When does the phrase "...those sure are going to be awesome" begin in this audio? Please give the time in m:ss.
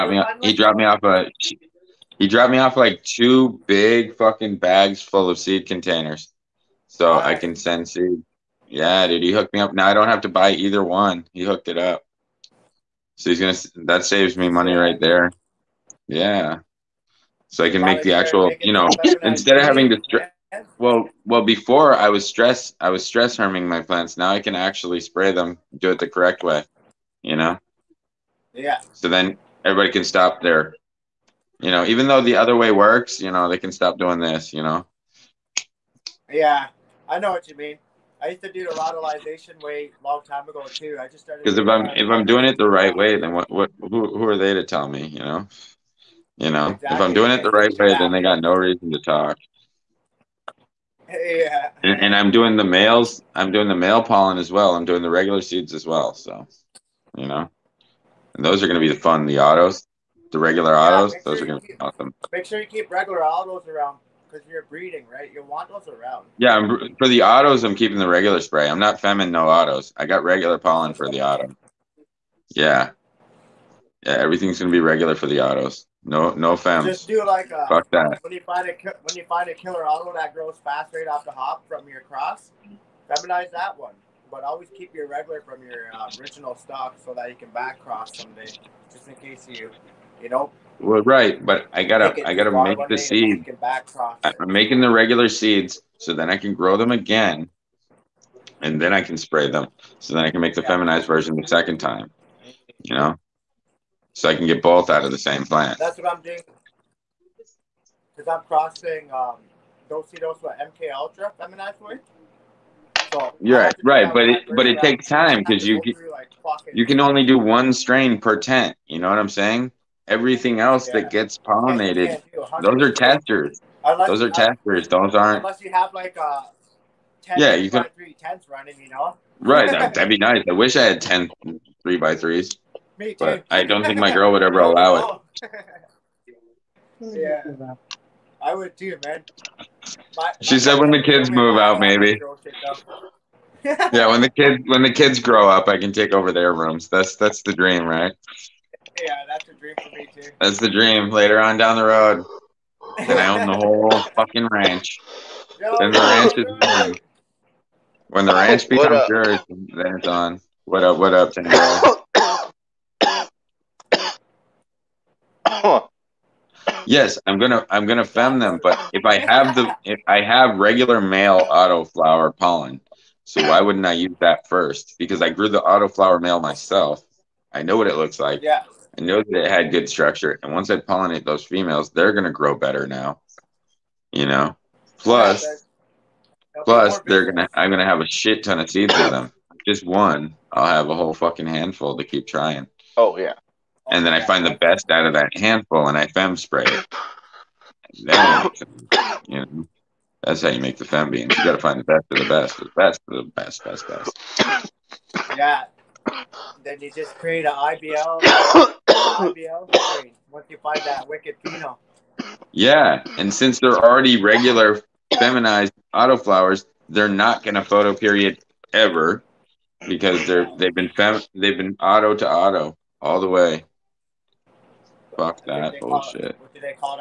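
1:01.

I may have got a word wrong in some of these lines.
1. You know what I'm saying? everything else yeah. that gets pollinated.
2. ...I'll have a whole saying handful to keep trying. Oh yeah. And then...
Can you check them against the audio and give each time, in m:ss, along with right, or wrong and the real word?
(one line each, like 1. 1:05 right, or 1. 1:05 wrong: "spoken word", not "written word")
1. 1:58 right
2. 3:10 wrong: "fucking", not "saying".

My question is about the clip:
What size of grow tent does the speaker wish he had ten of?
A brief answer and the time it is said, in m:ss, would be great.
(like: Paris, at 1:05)
3 by 3, at 2:11.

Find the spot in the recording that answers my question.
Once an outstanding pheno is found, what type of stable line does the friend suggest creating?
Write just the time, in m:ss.
3:27.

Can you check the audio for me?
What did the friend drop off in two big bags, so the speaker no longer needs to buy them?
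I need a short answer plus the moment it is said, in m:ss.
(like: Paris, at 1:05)
seed containers, at 0:05.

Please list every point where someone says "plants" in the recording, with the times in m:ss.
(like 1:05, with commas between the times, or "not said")
0:23, 1:45.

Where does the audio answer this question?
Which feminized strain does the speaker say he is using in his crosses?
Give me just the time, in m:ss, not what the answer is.
1:50.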